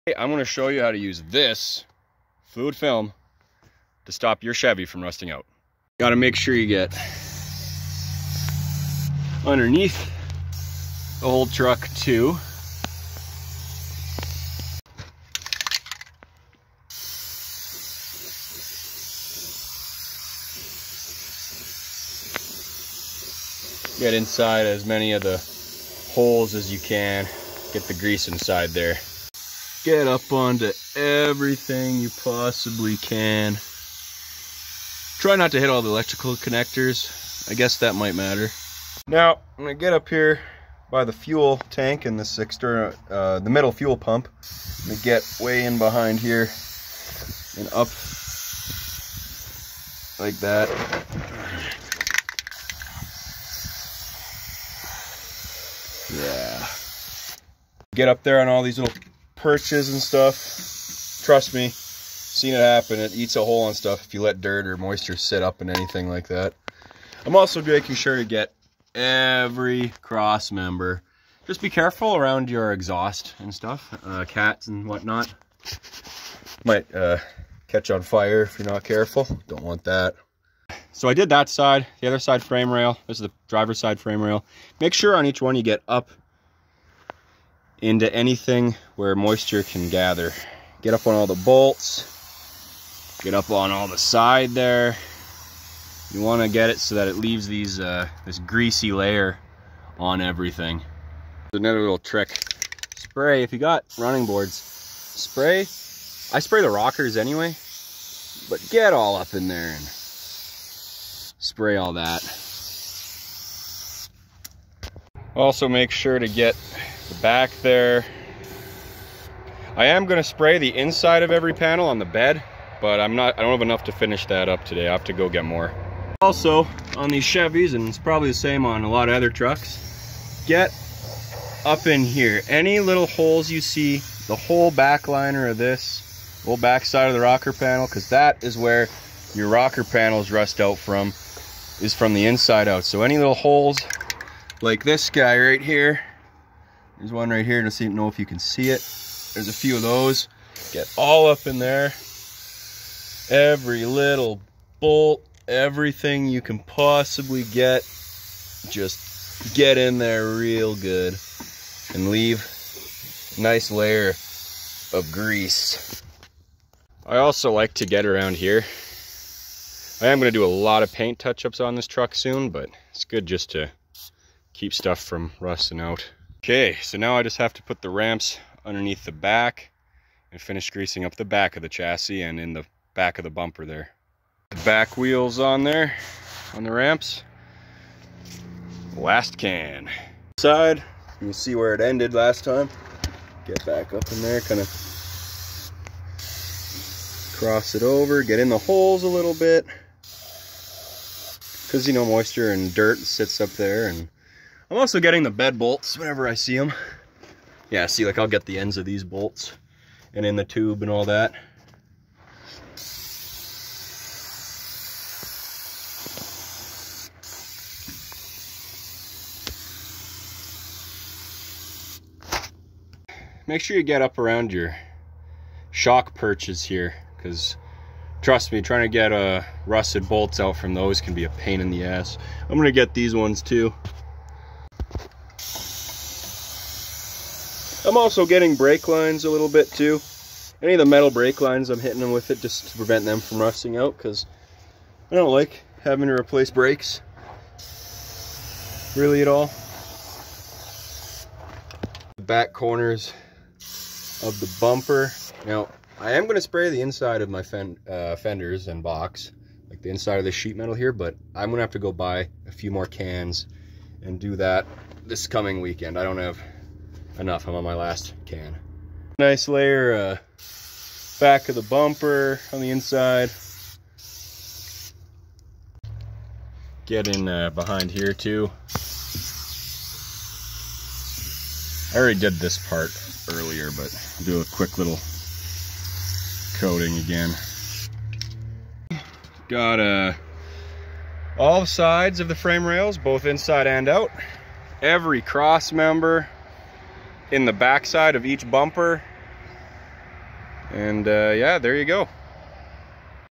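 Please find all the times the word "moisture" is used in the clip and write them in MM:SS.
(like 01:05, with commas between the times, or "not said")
01:04, 01:29, 03:22.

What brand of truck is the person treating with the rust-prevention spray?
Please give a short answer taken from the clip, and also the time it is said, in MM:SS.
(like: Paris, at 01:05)
Chevy, at 00:04.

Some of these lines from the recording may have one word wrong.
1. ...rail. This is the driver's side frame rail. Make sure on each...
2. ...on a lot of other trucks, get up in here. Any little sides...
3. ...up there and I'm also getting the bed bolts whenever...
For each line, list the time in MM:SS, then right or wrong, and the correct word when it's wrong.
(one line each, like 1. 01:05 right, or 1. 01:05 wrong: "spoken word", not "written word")
1. 01:22 right
2. 02:08 wrong: "holes", not "sides"
3. 03:23 right.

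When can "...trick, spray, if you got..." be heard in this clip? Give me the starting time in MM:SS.
01:41.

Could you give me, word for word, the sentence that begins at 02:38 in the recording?
Just get in there real good and leave a nice layer of grease.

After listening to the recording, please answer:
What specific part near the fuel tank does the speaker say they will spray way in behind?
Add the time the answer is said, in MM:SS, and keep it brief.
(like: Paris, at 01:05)
middle fuel pump, at 00:43.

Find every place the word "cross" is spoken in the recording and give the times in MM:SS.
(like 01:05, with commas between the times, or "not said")
01:10, 03:17, 04:55.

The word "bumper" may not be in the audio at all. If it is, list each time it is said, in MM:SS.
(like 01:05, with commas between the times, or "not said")
03:03, 04:14, 04:31, 04:58.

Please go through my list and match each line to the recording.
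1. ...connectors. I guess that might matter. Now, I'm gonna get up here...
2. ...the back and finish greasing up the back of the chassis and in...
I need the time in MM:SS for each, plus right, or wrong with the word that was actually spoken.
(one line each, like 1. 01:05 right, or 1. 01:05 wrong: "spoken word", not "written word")
1. 00:36 right
2. 02:59 right.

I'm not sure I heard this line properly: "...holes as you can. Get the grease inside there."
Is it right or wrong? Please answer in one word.
right.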